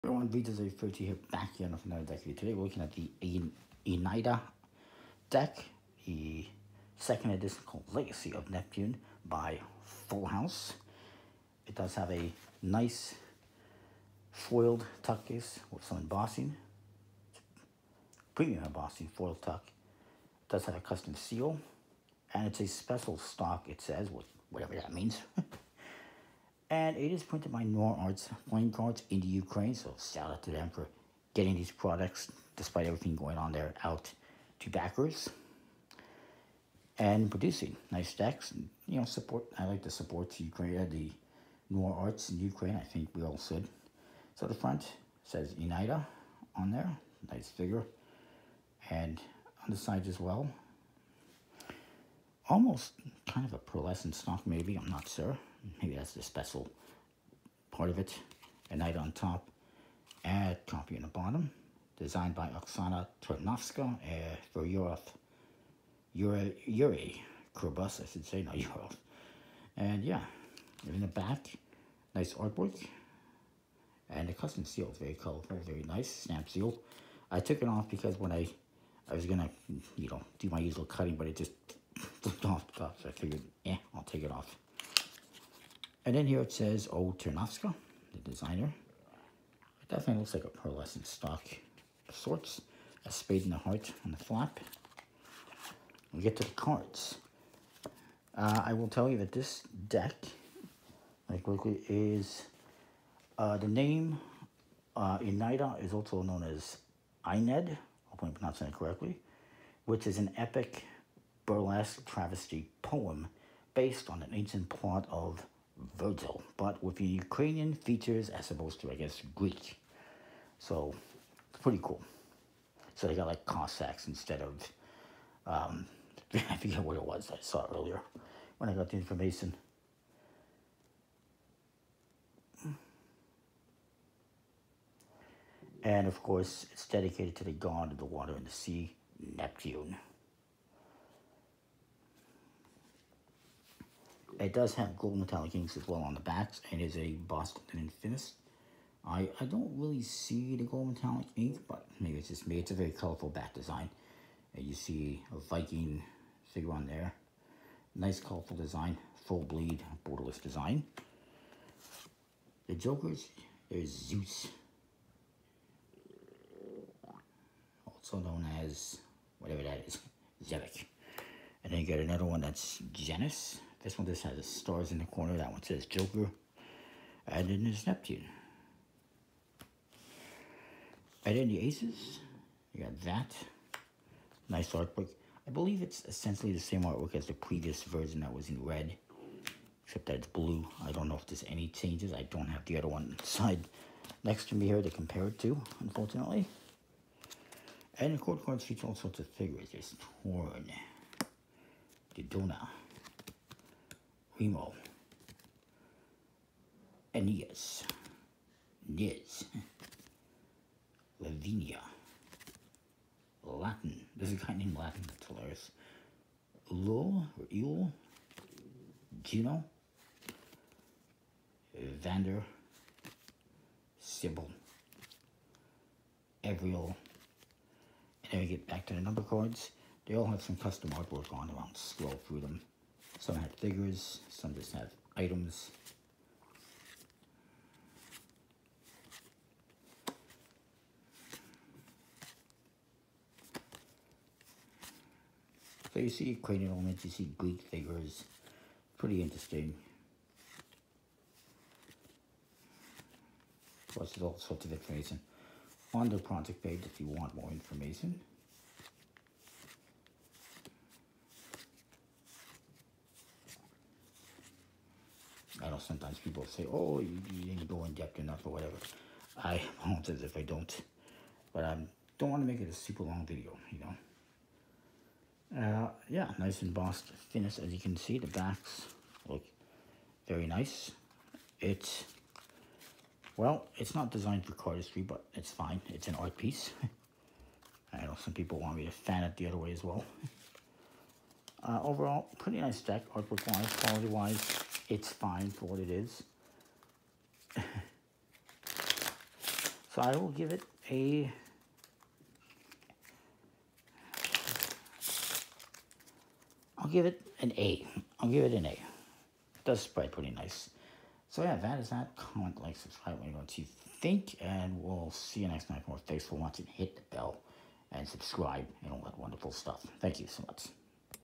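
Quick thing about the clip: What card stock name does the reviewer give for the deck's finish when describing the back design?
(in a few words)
Boston Infinis.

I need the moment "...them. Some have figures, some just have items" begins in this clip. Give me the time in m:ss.
3:52.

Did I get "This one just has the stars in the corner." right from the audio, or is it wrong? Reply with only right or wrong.
right.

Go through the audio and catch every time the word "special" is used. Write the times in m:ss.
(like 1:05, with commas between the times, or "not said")
0:22, 0:56.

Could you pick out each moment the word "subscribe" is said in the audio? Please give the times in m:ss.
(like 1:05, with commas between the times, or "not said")
5:12, 5:18.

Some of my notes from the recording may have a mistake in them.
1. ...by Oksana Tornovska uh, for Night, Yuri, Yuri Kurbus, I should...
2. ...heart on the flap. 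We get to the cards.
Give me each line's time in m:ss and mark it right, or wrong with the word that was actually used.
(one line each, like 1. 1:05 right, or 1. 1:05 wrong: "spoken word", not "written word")
1. 1:02 wrong: "Yurov", not "Night"
2. 1:33 right.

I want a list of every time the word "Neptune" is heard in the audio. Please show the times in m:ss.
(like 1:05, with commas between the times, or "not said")
0:08, 2:19, 2:57.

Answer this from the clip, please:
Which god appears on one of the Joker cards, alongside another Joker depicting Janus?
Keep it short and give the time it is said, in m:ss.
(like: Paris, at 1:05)
Zeus, at 2:43.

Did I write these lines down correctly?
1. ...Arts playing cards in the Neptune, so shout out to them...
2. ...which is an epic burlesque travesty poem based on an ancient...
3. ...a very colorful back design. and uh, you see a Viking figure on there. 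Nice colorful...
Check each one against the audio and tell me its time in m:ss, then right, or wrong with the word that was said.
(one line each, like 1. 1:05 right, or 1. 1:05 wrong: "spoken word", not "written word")
1. 0:27 wrong: "Ukraine", not "Neptune"
2. 1:49 right
3. 2:32 right.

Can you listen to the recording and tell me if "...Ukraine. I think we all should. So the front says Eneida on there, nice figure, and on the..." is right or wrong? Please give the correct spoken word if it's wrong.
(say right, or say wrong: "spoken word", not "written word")
right.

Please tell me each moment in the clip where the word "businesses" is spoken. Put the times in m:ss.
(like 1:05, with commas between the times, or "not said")
not said.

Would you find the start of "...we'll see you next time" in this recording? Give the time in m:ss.
5:14.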